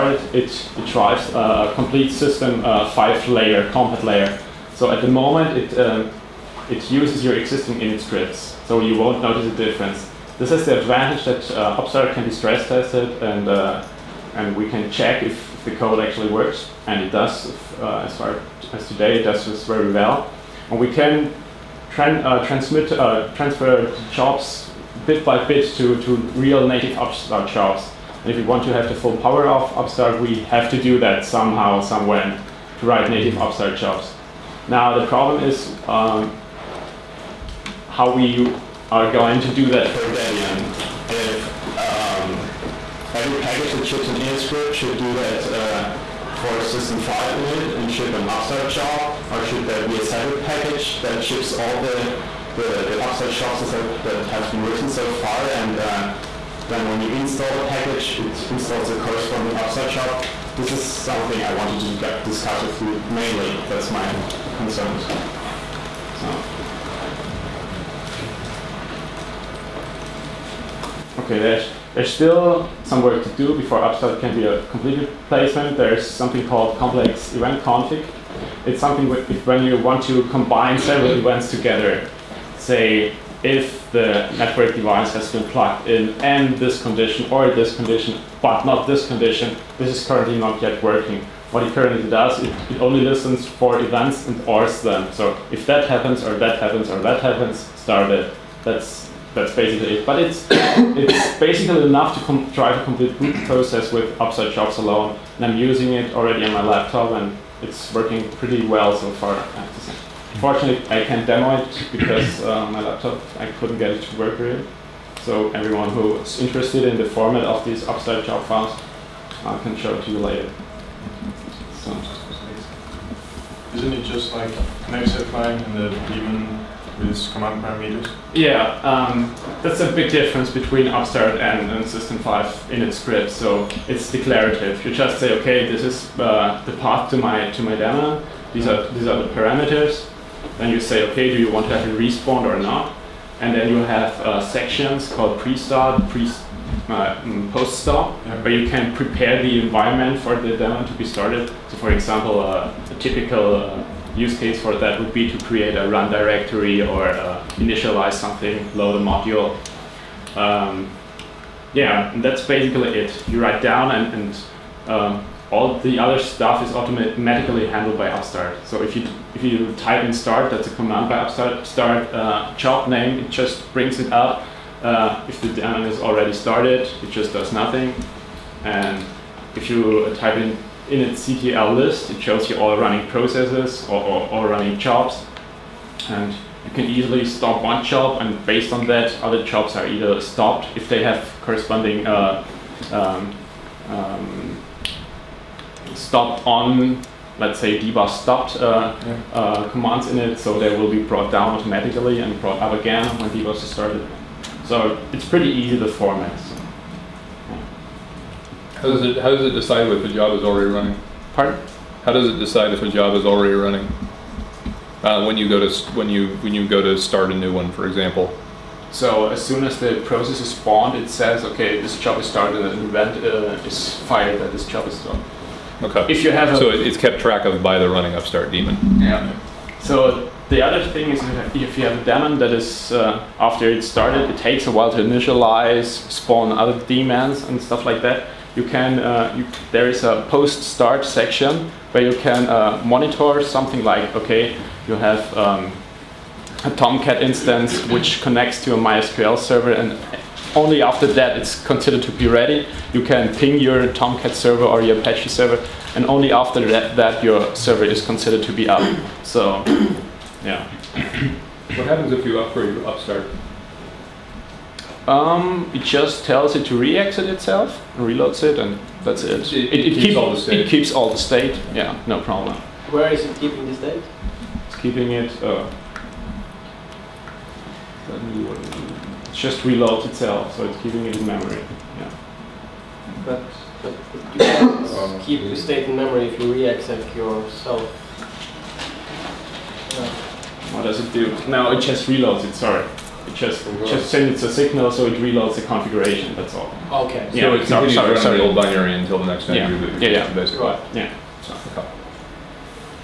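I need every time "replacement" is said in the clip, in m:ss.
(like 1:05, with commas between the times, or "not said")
1:15.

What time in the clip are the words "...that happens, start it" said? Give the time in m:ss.
1:37.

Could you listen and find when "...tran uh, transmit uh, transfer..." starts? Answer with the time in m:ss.
0:21.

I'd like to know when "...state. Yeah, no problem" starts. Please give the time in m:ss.
4:31.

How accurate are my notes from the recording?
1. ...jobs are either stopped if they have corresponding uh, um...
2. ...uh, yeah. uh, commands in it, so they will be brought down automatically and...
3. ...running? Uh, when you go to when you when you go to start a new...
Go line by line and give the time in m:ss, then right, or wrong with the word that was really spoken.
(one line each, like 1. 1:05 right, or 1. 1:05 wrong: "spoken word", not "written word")
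1. 3:09 right
2. 3:18 right
3. 3:33 right.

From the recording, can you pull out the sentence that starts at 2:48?
So if you if you type in start, that's a command by Upstart, start uh, job name, it just brings it up.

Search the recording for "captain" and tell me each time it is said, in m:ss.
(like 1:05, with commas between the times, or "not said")
not said.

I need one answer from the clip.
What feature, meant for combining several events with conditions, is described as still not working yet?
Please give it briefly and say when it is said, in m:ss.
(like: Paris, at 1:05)
complex event config, at 1:16.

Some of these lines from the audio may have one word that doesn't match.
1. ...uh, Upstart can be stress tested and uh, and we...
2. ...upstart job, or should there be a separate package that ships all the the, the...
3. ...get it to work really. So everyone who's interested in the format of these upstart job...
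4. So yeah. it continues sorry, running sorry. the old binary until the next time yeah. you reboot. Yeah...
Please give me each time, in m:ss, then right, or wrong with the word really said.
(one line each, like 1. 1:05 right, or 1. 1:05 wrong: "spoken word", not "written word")
1. 0:11 right
2. 0:48 right
3. 1:53 right
4. 4:57 right.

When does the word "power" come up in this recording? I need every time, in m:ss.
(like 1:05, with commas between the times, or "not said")
0:29.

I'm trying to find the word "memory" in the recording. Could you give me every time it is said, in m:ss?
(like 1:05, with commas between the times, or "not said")
4:41, 4:45.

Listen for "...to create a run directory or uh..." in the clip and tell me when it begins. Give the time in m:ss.
2:35.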